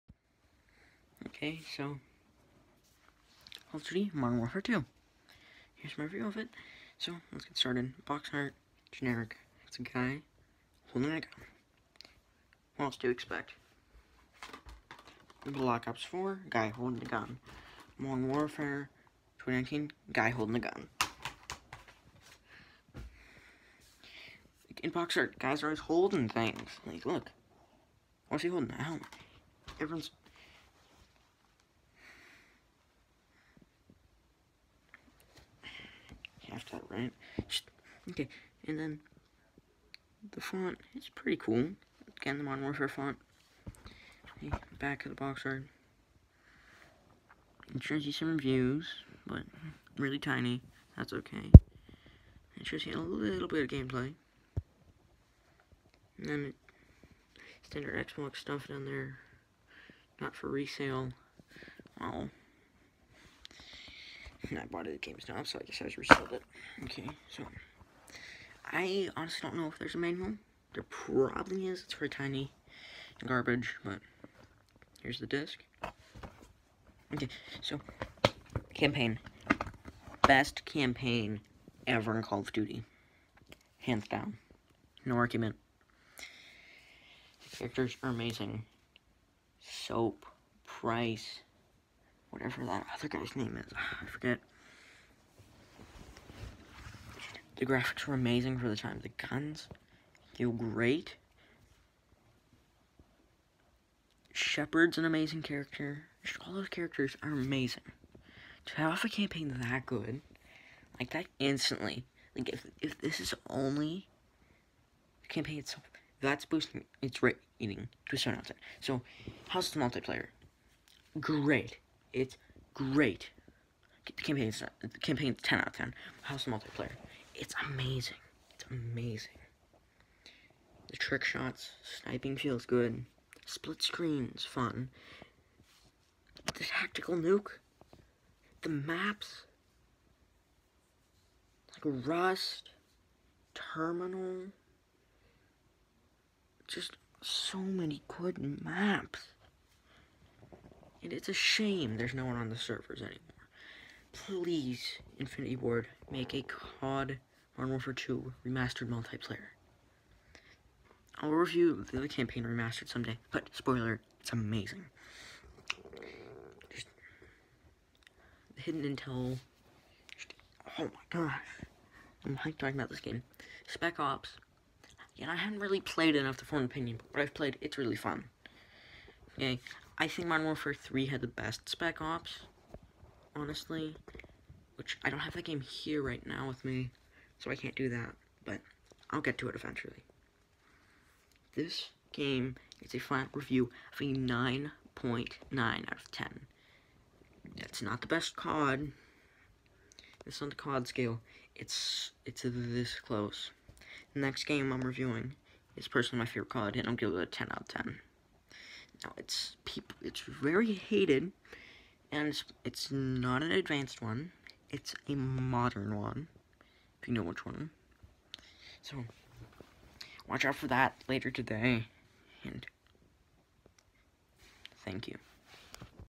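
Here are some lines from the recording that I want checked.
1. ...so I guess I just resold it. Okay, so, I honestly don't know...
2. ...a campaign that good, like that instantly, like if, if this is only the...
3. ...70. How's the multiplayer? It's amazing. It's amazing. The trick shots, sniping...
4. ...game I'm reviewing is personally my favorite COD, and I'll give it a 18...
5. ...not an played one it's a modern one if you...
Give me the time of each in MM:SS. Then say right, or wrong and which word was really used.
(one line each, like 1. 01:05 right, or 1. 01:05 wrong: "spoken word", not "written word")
1. 01:05 right
2. 01:49 right
3. 02:05 wrong: "10", not "70"
4. 03:24 wrong: "10", not "18"
5. 03:32 wrong: "advanced", not "played".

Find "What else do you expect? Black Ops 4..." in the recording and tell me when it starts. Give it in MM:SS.
00:12.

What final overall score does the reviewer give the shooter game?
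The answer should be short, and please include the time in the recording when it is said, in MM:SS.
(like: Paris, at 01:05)
9.9 out of 10, at 03:14.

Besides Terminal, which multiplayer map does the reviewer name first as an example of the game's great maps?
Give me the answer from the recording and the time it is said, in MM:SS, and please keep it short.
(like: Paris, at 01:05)
Rust, at 02:22.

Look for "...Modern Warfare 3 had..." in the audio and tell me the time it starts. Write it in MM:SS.
03:00.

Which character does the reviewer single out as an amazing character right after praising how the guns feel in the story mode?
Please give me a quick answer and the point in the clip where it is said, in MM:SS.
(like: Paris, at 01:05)
Shepherd, at 01:44.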